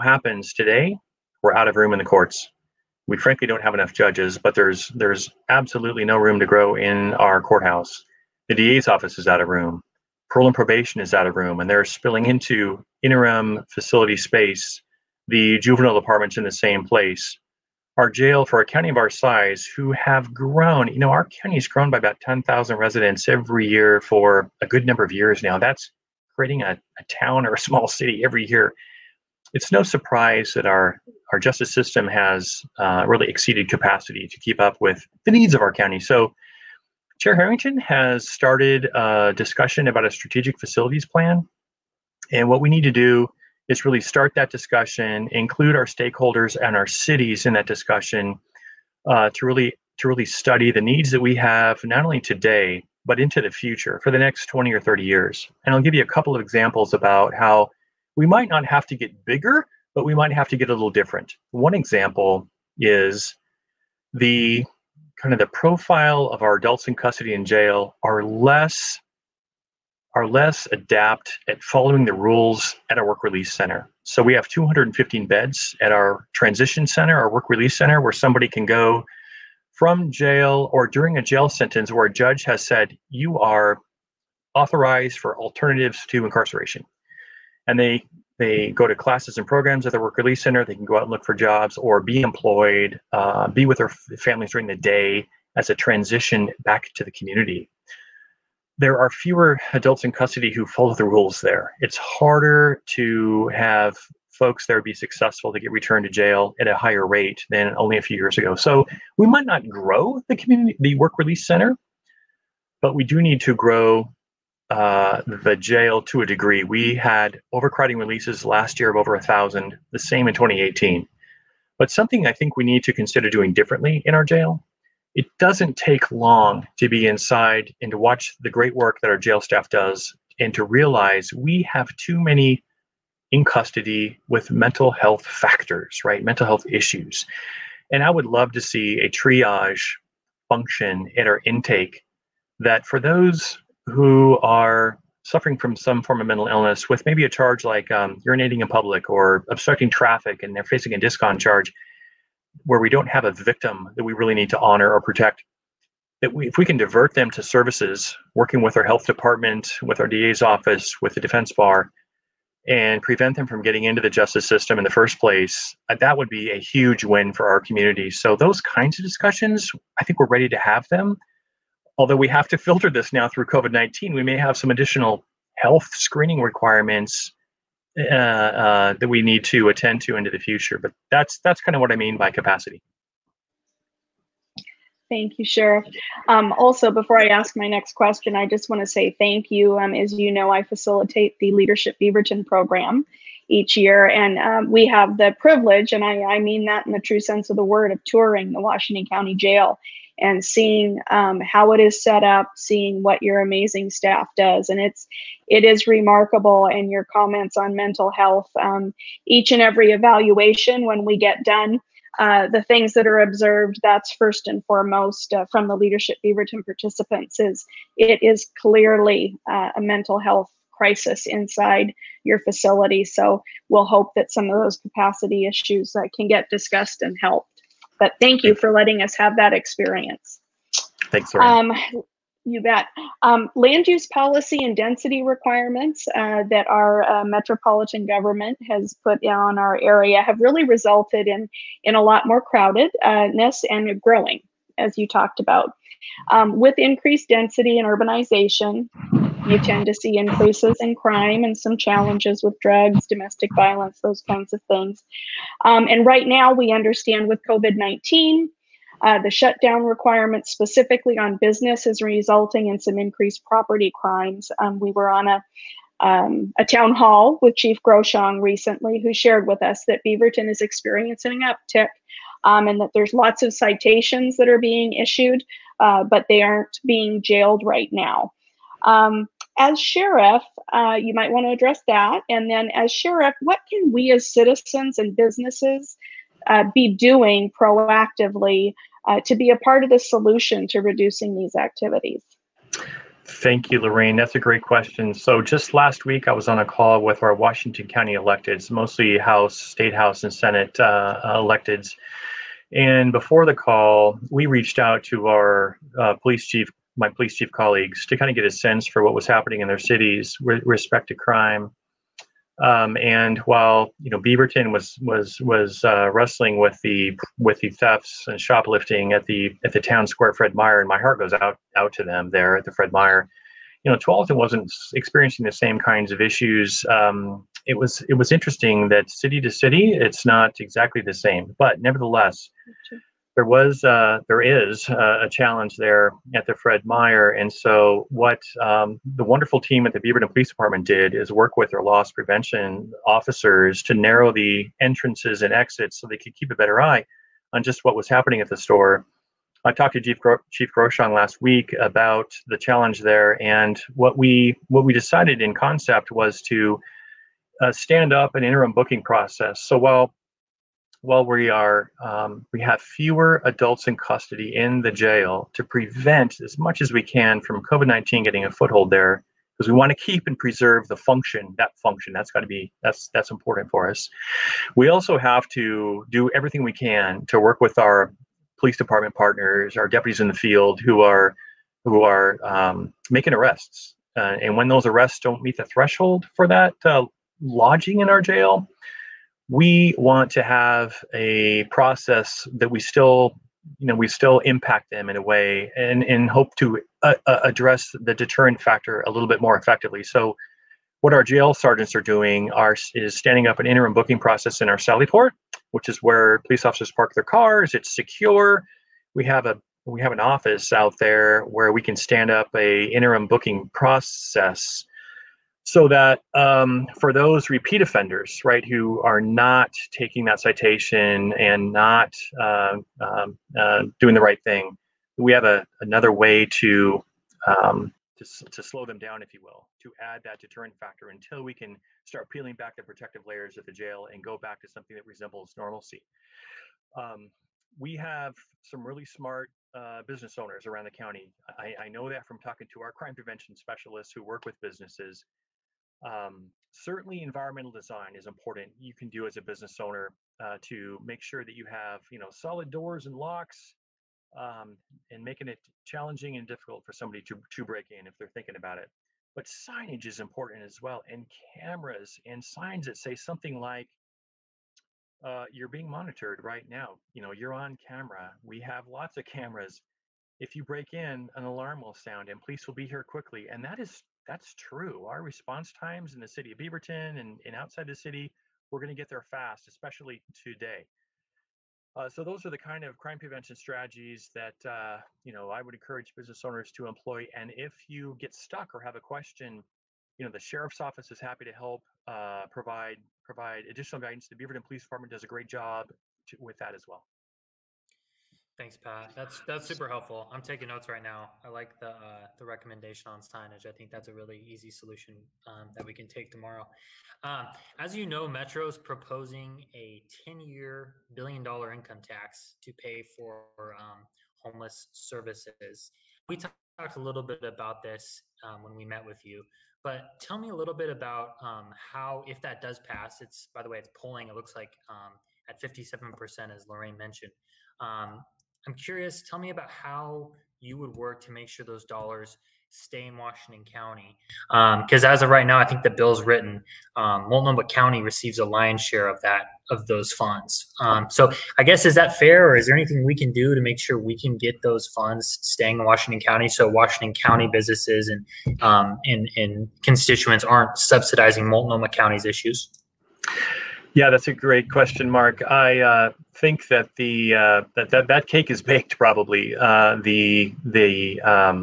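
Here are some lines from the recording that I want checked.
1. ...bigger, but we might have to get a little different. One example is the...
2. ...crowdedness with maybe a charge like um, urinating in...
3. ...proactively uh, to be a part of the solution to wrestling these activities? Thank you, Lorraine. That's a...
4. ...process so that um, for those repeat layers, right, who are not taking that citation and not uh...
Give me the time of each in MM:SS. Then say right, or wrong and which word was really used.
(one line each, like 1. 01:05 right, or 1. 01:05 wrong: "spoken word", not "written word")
1. 00:59 right
2. 02:26 wrong: "illness", not "crowdedness"
3. 04:47 wrong: "reducing", not "wrestling"
4. 06:53 wrong: "offenders", not "layers".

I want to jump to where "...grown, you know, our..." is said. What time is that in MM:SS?
00:20.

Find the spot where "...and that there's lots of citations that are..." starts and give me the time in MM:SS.
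04:32.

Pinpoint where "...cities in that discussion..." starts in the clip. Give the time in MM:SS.
00:46.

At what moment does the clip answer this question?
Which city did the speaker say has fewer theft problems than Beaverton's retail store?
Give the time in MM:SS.
05:23.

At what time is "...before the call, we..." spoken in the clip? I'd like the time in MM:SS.
05:03.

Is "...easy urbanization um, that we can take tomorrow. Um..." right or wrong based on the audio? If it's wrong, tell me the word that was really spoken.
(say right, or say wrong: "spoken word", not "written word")
wrong: "solution", not "urbanization".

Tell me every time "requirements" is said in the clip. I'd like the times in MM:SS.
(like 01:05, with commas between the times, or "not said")
02:56, 03:55, 04:19.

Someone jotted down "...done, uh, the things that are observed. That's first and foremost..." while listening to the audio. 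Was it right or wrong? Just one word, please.
right.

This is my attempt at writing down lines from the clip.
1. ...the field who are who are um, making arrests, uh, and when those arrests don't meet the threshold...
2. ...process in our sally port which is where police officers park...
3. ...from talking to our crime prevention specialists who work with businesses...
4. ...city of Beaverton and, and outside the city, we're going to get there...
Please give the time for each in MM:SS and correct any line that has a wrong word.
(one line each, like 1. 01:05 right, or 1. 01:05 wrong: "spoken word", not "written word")
1. 06:20 right
2. 06:44 right
3. 07:22 right
4. 07:56 right.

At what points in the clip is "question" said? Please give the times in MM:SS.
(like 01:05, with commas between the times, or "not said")
03:07, 04:54, 08:08, 09:14.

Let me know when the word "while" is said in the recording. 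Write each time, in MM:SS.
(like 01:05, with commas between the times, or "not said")
05:13, 05:59.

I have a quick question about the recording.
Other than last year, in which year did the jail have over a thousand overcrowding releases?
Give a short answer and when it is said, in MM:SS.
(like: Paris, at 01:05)
2018, at 02:00.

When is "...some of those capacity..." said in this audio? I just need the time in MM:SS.
03:44.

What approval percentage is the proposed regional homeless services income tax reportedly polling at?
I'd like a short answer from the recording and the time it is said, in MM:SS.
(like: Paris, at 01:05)
57%, at 08:45.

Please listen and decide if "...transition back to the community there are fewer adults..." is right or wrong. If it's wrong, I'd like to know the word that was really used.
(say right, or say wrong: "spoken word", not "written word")
right.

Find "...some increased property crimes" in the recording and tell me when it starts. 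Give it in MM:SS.
04:22.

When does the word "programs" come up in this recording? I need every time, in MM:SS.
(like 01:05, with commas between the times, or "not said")
01:29, 03:12.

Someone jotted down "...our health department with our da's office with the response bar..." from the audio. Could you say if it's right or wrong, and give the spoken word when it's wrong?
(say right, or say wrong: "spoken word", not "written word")
wrong: "defense", not "response".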